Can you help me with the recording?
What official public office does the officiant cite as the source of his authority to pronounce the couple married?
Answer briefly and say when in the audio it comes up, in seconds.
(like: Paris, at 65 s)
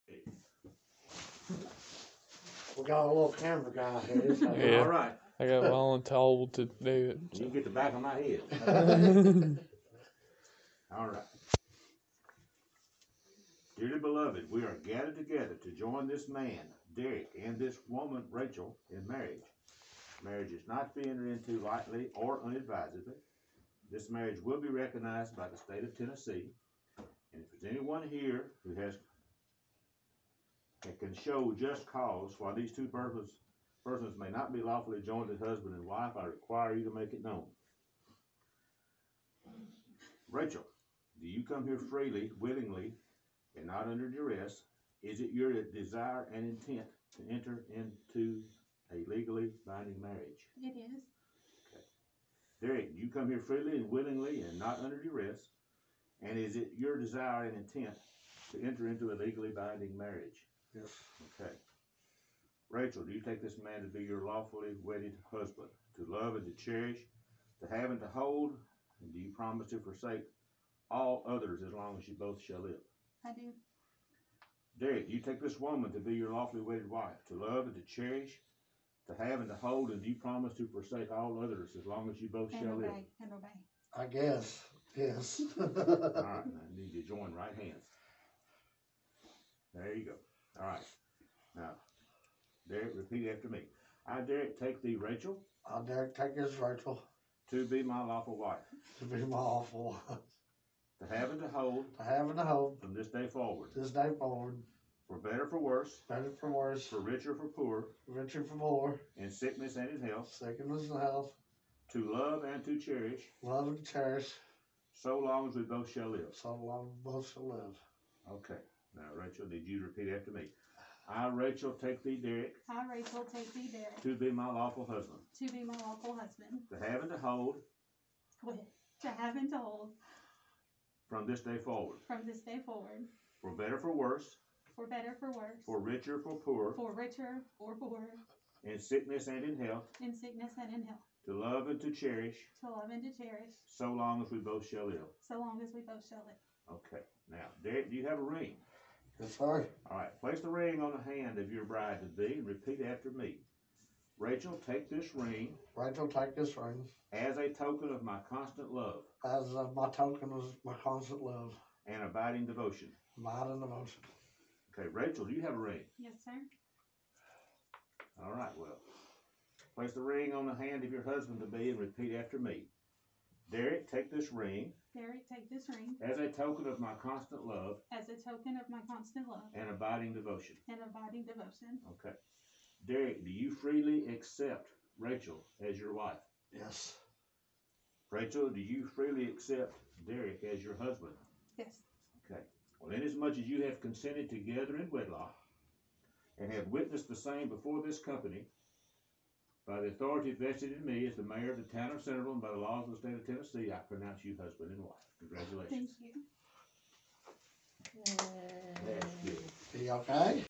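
mayor, at 201 s.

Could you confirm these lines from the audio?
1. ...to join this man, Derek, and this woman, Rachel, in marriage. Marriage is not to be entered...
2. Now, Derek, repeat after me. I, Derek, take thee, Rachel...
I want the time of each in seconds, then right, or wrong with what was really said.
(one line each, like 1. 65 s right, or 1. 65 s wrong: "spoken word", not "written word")
1. 15 s right
2. 91 s right.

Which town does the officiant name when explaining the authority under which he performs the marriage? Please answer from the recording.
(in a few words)
Centerville.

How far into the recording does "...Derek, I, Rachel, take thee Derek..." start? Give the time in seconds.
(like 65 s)
122 s.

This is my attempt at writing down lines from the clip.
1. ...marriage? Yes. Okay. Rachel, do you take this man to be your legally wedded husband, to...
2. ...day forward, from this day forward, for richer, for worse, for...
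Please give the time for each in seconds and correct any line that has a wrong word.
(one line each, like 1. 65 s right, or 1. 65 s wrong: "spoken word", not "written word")
1. 59 s wrong: "lawfully", not "legally"
2. 131 s wrong: "better", not "richer".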